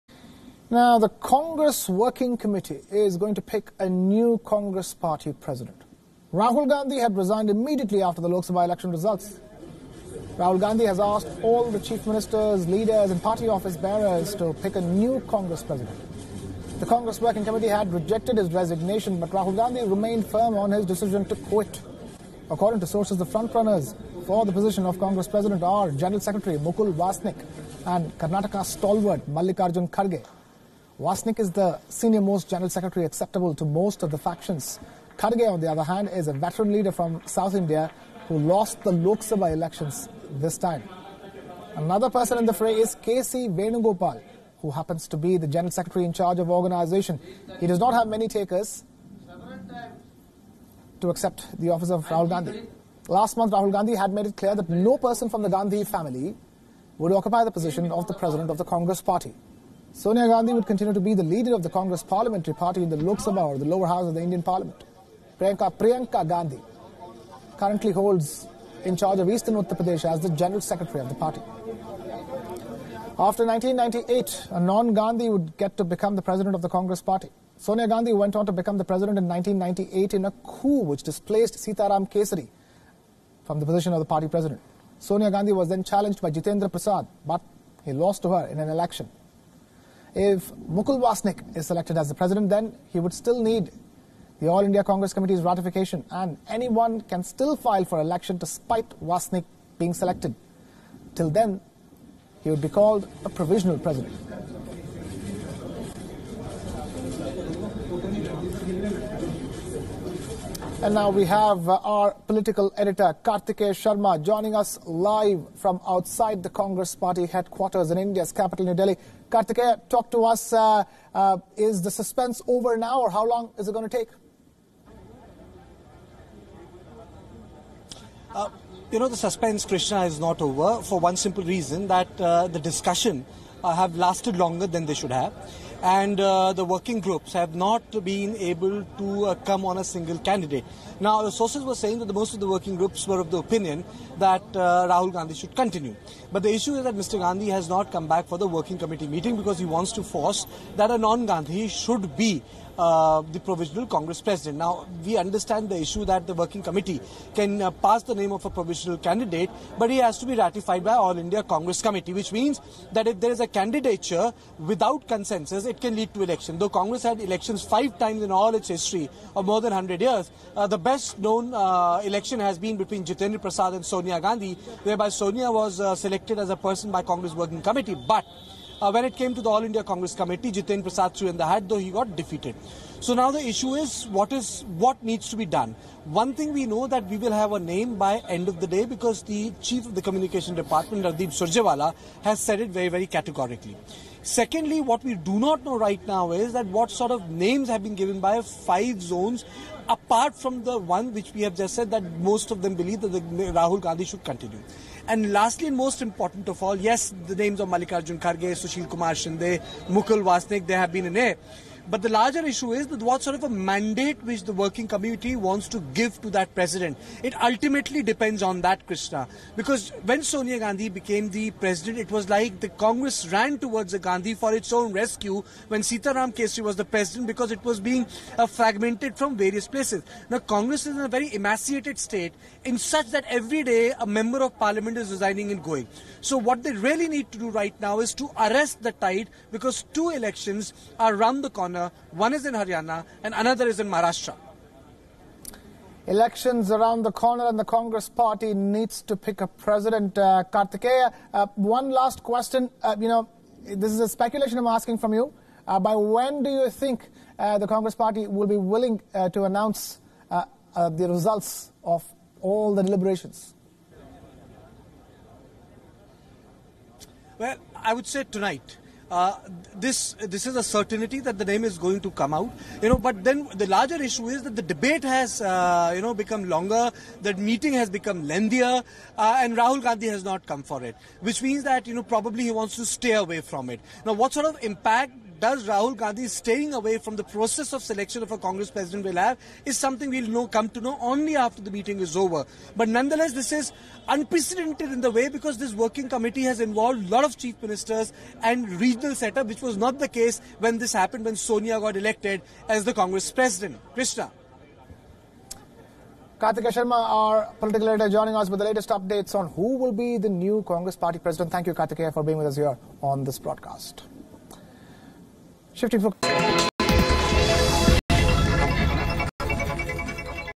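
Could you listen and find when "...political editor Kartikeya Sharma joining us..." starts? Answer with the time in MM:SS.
01:52.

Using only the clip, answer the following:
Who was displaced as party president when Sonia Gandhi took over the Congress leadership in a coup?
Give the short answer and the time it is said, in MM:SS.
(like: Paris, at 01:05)
Sitaram Kesari, at 01:21.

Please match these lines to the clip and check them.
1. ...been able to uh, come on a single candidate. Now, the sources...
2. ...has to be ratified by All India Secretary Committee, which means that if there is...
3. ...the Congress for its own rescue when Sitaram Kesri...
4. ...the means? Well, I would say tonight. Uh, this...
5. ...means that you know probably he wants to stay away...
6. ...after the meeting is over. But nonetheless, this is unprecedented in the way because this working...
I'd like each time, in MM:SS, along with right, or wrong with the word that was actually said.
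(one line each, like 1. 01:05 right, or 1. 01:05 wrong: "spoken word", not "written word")
1. 02:18 right
2. 02:39 wrong: "Congress", not "Secretary"
3. 03:43 wrong: "Gandhi", not "Congress"
4. 04:22 wrong: "deliberations", not "means"
5. 04:41 right
6. 04:51 right.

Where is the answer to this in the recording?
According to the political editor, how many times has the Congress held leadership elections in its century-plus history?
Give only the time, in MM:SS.
02:47.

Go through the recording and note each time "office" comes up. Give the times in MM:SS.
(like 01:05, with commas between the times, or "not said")
00:13, 00:51.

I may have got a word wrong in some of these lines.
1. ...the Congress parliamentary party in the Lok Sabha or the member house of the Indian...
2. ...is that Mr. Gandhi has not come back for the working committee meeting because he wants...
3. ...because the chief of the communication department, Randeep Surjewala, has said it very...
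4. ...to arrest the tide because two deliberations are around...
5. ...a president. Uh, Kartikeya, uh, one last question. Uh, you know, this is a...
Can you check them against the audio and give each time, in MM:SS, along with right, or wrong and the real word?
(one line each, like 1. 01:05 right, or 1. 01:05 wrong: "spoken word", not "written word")
1. 01:01 wrong: "lower", not "member"
2. 02:26 right
3. 03:08 right
4. 03:58 wrong: "elections", not "deliberations"
5. 04:09 right.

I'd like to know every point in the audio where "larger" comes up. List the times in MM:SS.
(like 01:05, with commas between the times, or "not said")
03:32, 04:33.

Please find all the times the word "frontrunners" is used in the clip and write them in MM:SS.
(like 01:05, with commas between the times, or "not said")
00:23.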